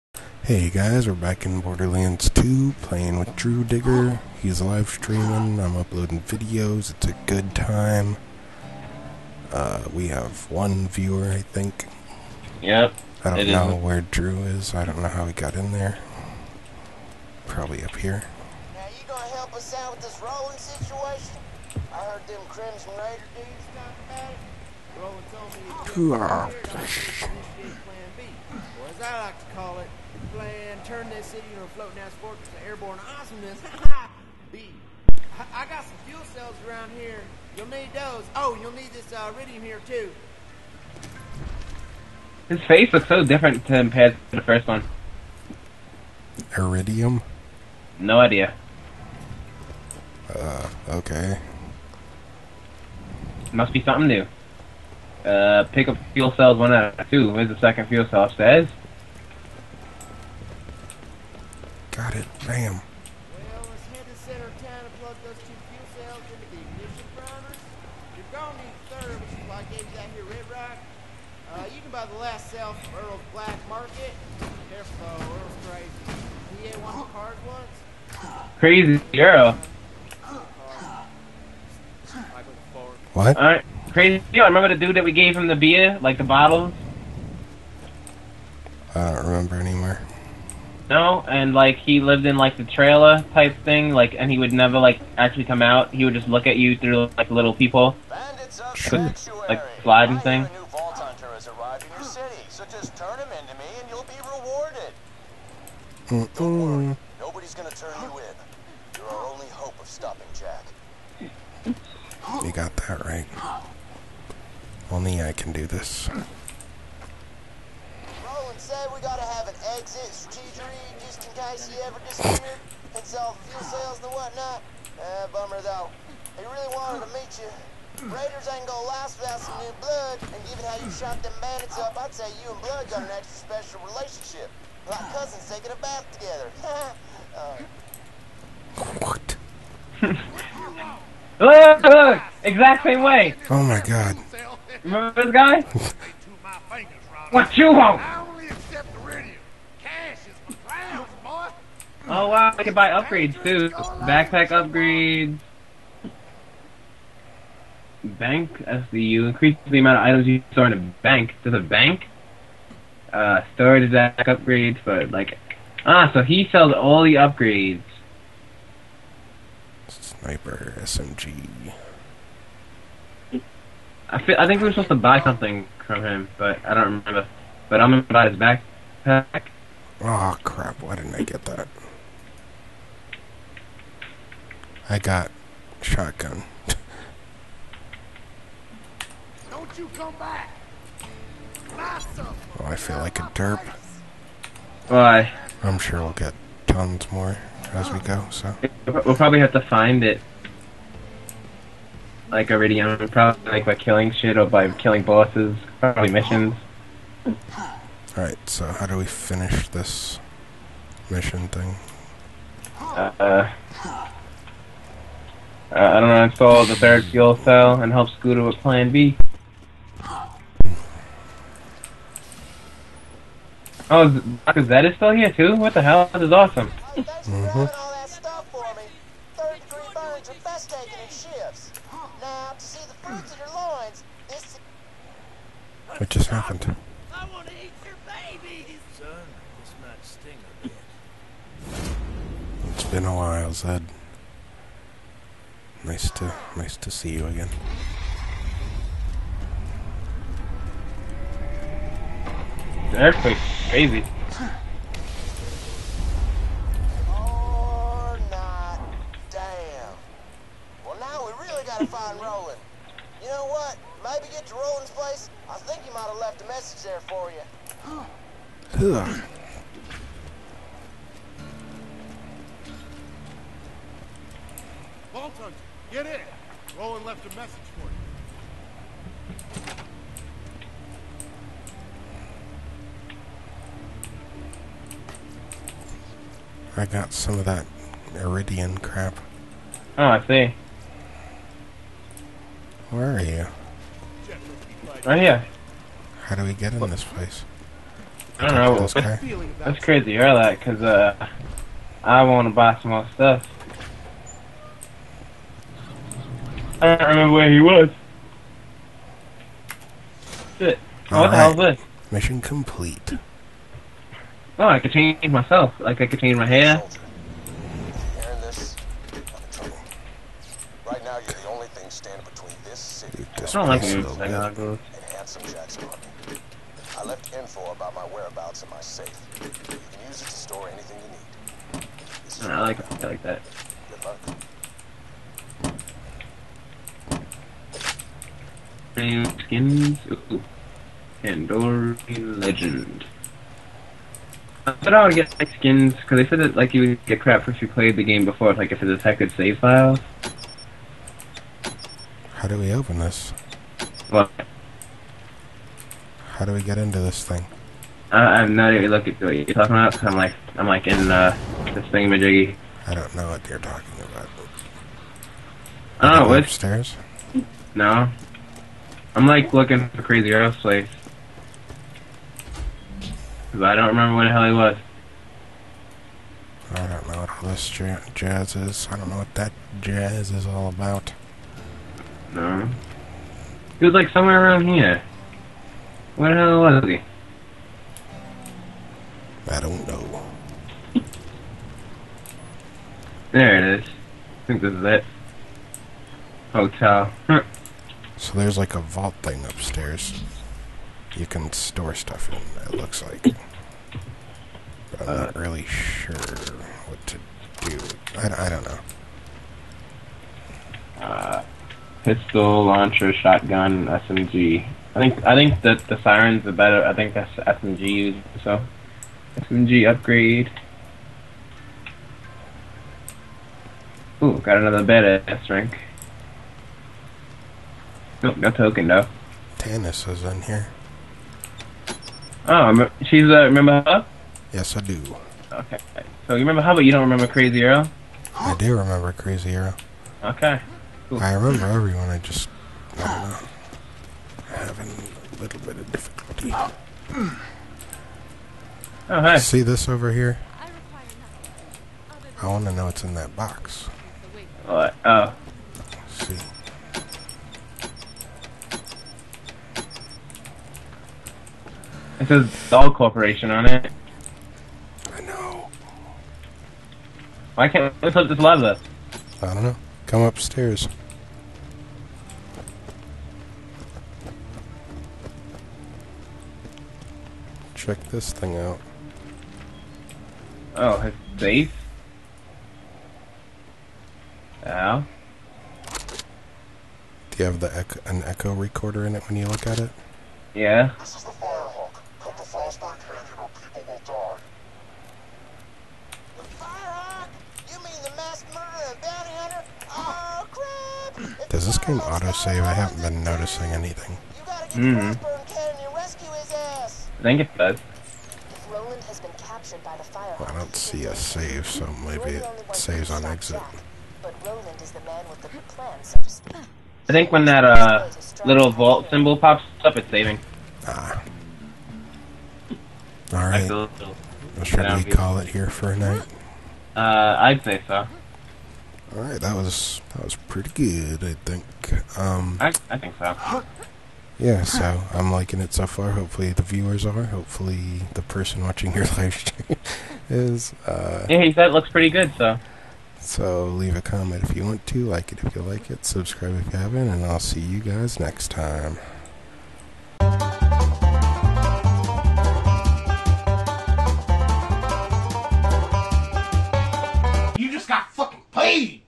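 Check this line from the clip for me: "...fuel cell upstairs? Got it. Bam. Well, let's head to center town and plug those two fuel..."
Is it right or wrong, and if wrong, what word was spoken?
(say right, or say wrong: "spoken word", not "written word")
right.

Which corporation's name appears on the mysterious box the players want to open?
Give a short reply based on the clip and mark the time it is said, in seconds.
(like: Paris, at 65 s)
Dahl Corporation, at 462 s.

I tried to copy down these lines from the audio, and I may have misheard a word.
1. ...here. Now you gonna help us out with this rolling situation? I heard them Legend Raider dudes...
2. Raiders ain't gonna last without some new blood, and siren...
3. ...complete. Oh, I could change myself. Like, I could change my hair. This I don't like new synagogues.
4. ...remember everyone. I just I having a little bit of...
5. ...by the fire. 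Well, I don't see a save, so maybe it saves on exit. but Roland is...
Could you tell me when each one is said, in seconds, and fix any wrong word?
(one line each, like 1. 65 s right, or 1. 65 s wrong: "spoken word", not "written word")
1. 17 s wrong: "Crimson", not "Legend"
2. 128 s wrong: "given", not "siren"
3. 312 s right
4. 441 s right
5. 509 s right.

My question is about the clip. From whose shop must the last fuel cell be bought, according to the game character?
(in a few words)
Earl's Black Market.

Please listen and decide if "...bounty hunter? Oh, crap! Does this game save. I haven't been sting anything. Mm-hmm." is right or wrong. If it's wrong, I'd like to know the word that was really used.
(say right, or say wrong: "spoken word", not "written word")
wrong: "noticing", not "sting".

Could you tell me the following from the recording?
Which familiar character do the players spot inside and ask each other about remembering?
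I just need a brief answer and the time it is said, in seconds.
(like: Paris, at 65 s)
Tannis, at 429 s.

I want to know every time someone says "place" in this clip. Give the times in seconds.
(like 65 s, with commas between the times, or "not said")
264 s, 297 s, 370 s.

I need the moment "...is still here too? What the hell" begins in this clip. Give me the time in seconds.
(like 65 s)
224 s.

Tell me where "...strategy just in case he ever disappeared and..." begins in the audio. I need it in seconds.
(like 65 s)
120 s.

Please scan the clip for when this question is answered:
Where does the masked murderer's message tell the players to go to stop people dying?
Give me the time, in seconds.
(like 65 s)
492 s.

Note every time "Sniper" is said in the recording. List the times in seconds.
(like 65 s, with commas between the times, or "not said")
169 s.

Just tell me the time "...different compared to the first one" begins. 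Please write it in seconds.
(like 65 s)
43 s.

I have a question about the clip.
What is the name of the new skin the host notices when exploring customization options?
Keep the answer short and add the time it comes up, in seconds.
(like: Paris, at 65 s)
Andorian Legend, at 341 s.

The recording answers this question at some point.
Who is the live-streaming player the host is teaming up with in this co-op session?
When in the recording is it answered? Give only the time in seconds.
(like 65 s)
3 s.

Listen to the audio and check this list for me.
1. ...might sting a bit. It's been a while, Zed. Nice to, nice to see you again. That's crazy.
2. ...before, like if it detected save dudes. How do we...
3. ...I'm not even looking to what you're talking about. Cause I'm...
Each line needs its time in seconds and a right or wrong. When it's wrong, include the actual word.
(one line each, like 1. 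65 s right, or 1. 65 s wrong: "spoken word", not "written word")
1. 239 s right
2. 348 s wrong: "files", not "dudes"
3. 358 s right.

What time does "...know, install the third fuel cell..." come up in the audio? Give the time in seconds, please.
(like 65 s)
216 s.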